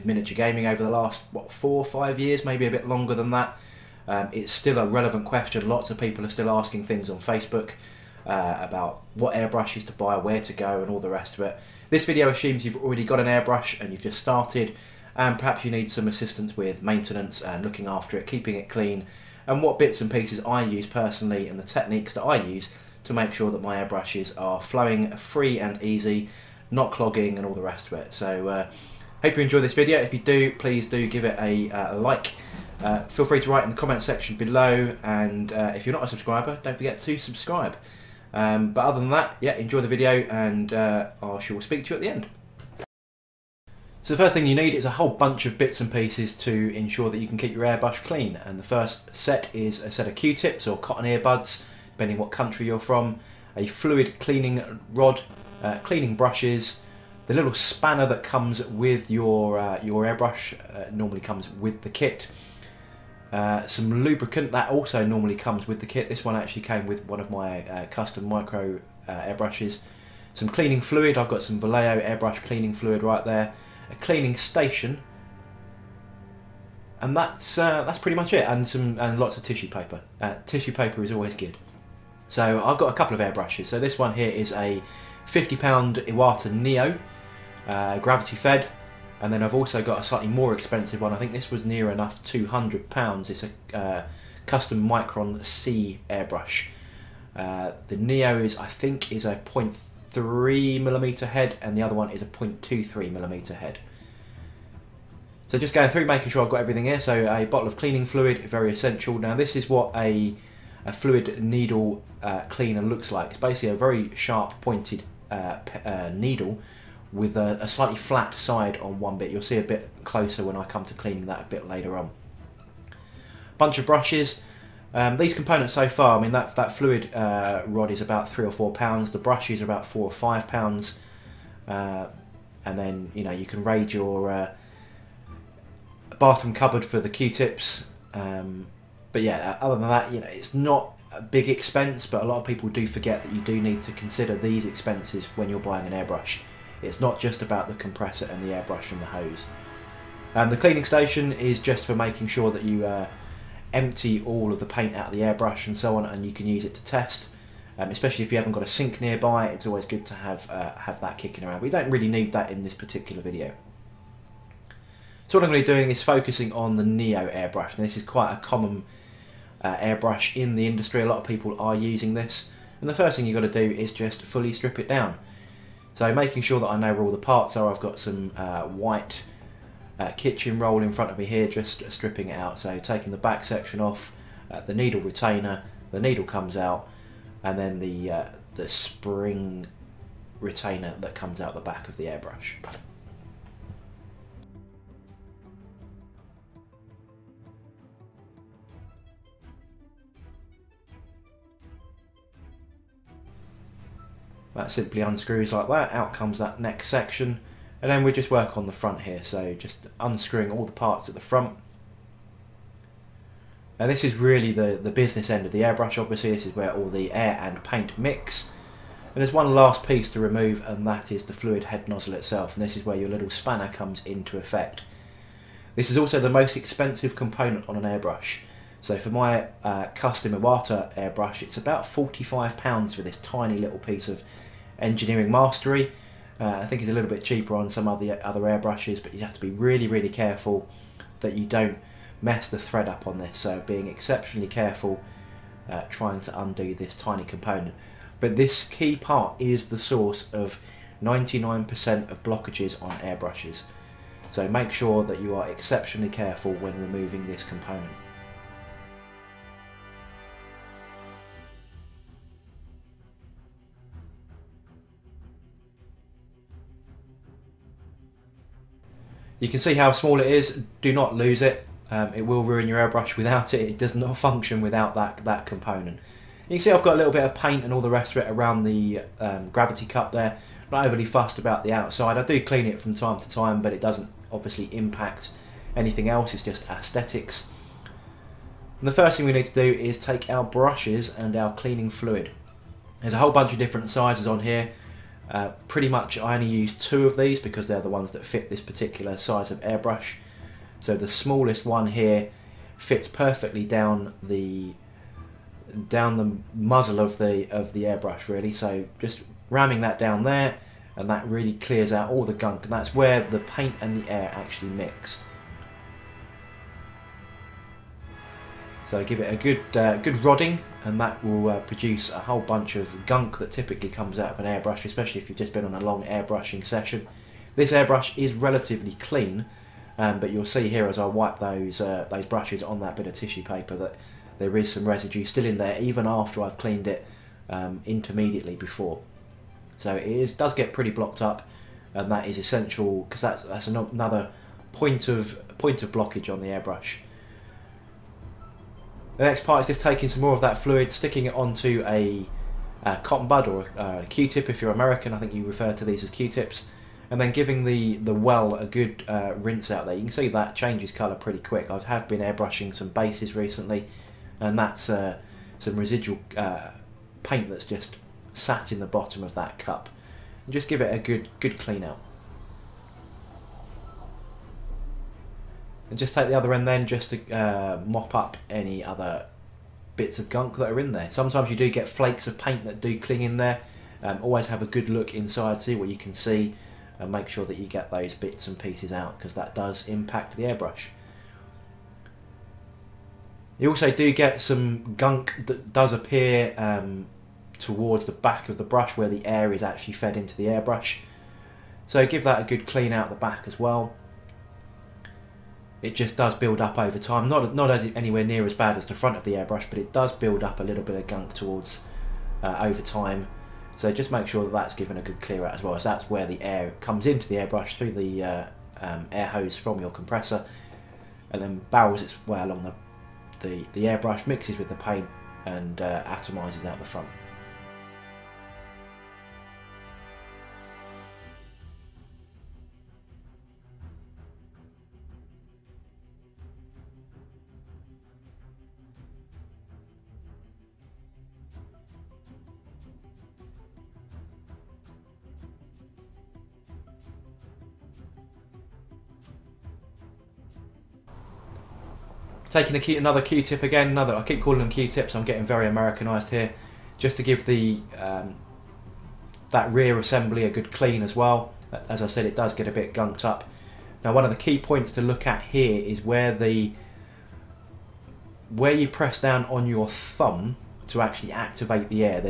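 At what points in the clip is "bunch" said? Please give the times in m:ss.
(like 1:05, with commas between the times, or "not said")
0:45, 2:03, 4:53, 5:22.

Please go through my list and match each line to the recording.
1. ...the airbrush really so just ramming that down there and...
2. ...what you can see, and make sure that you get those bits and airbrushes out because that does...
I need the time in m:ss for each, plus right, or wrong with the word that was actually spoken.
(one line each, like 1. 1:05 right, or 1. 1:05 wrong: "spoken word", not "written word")
1. 5:07 right
2. 6:25 wrong: "pieces", not "airbrushes".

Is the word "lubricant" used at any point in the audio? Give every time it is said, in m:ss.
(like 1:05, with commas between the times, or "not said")
1:04.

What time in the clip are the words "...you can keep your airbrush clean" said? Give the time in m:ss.
0:47.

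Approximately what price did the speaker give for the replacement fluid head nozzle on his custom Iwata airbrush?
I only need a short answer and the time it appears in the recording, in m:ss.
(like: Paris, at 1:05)
£45, at 3:51.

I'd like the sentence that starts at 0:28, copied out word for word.
So uh, hope you enjoy this video.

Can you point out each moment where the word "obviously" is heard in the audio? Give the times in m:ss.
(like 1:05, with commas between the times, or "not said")
3:35, 4:44.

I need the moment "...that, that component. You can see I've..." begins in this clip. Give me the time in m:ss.
4:34.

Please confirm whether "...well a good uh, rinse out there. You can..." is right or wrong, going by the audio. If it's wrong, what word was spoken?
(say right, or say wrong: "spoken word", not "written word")
right.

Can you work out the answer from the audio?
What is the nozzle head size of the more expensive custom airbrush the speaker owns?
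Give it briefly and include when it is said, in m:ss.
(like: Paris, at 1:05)
0.23 millimeter, at 1:42.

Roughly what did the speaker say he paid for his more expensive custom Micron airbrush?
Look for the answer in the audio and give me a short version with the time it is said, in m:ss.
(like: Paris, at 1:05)
200 pounds, at 1:32.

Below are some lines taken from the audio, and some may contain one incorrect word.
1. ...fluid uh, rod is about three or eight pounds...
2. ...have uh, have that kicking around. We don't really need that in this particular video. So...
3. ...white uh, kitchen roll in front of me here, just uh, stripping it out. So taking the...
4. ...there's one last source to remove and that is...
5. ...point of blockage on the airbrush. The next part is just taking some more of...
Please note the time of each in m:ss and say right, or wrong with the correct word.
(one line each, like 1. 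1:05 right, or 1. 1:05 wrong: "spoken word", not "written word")
1. 2:06 wrong: "four", not "eight"
2. 2:40 right
3. 2:58 right
4. 3:39 wrong: "piece", not "source"
5. 5:45 right.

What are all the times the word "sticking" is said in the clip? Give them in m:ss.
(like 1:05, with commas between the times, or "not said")
5:50.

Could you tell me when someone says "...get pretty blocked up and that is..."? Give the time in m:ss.
5:40.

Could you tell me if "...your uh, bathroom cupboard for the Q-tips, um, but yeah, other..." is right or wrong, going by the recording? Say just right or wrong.
right.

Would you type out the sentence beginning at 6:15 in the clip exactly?
and just take the other end then just to uh, mop up any other bits of gunk that are in there.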